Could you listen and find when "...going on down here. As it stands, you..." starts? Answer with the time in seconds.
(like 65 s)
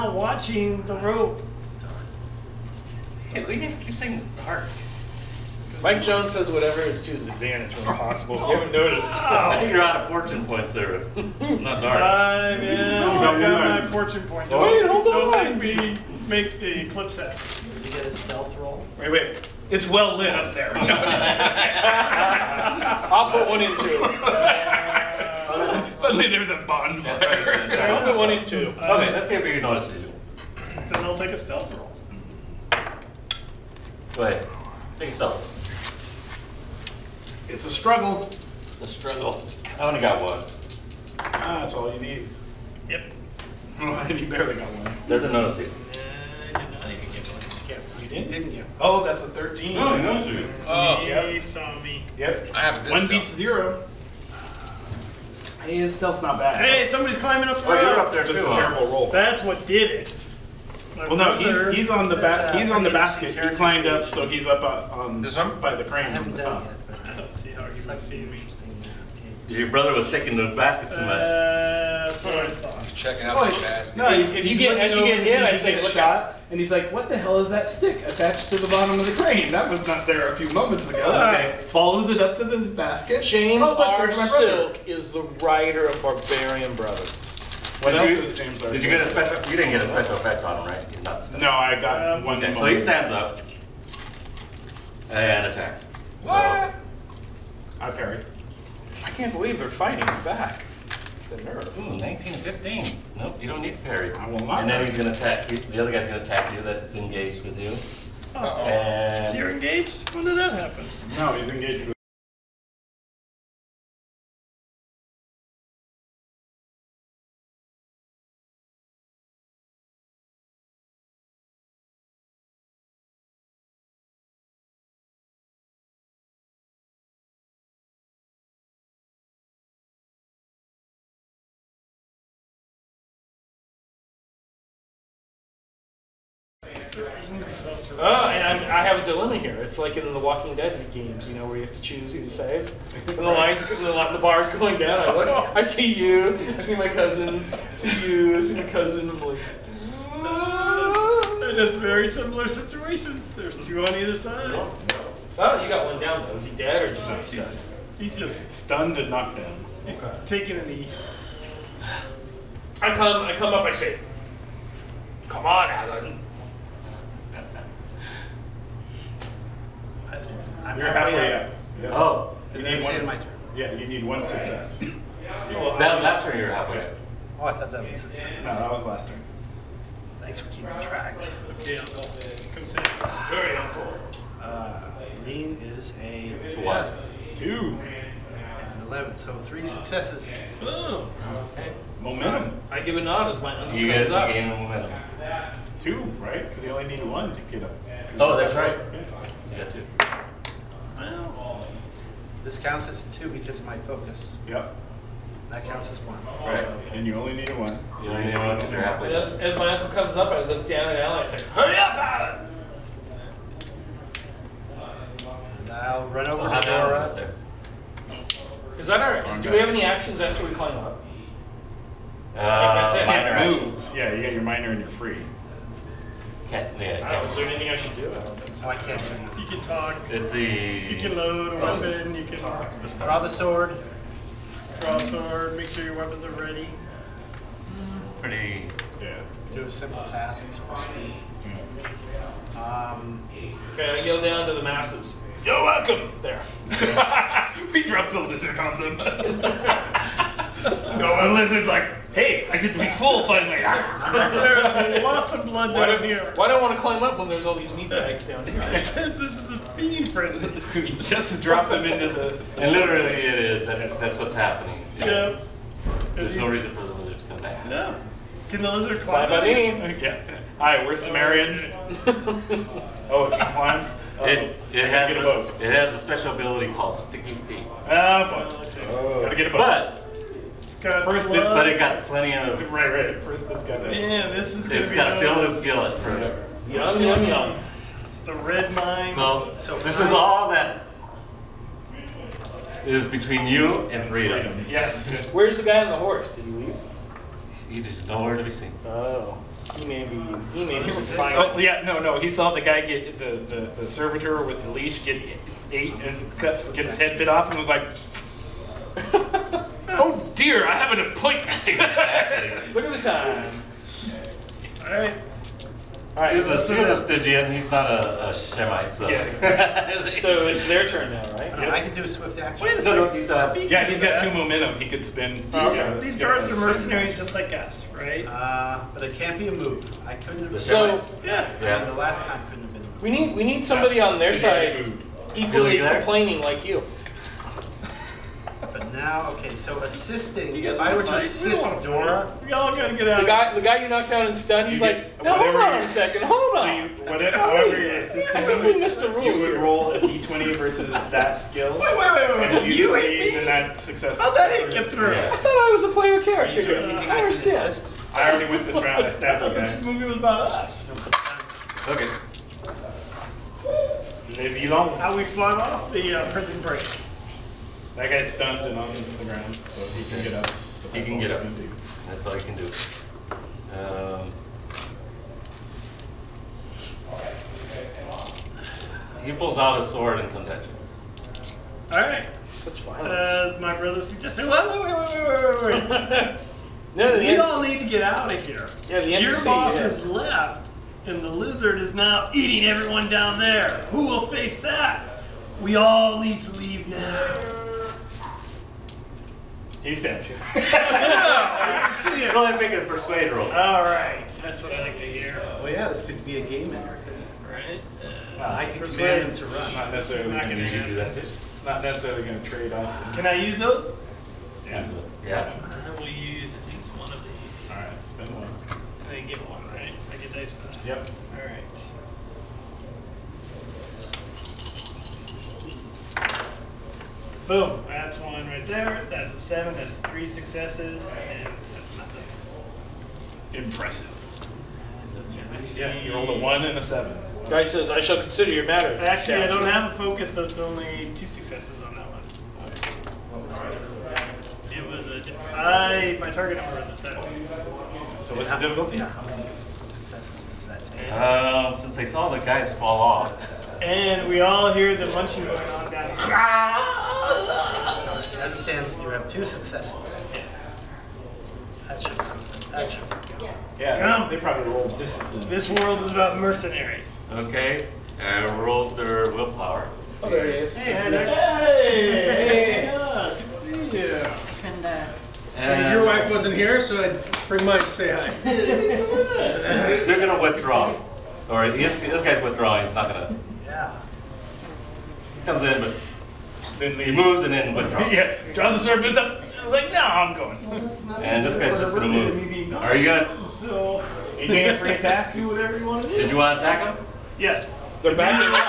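455 s.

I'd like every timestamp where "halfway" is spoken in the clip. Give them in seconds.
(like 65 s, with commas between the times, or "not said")
170 s, 176 s.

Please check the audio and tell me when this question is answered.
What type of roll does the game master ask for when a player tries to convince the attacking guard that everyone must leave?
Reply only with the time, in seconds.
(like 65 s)
402 s.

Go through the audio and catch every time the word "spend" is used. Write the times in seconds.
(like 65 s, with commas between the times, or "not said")
418 s.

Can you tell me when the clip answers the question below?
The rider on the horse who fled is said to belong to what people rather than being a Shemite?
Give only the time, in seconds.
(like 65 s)
316 s.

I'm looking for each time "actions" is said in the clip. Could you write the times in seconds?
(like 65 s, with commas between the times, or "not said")
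219 s, 322 s.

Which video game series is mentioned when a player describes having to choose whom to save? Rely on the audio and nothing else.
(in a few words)
The Walking Dead.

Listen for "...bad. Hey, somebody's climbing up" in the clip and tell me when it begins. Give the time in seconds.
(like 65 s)
56 s.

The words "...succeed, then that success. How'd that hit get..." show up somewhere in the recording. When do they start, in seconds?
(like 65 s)
352 s.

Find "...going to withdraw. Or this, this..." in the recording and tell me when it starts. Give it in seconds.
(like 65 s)
480 s.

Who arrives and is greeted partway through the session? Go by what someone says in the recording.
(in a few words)
Heather.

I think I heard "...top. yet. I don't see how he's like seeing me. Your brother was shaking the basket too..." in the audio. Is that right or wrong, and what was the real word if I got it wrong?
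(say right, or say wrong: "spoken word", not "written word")
right.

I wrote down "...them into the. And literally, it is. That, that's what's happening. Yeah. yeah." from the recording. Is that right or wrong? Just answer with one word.
right.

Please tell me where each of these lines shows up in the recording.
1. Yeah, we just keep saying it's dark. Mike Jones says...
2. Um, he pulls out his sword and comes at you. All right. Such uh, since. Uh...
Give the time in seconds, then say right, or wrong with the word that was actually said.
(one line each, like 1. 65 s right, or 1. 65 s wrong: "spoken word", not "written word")
1. 3 s right
2. 373 s wrong: "violence", not "since".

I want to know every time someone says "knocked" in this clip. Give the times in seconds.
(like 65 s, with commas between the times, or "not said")
159 s, 343 s.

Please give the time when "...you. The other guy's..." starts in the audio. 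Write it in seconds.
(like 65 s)
105 s.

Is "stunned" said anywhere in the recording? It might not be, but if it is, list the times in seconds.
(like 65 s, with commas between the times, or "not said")
158 s, 344 s, 368 s.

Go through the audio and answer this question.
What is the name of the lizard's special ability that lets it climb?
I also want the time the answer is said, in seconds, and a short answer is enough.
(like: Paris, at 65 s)
Sticky Feet, at 276 s.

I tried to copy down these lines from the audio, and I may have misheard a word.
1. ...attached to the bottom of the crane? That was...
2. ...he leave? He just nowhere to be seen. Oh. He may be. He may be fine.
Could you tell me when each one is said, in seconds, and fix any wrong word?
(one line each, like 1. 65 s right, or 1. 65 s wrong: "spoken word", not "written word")
1. 78 s right
2. 296 s right.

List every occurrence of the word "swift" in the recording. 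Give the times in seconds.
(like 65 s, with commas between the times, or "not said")
322 s.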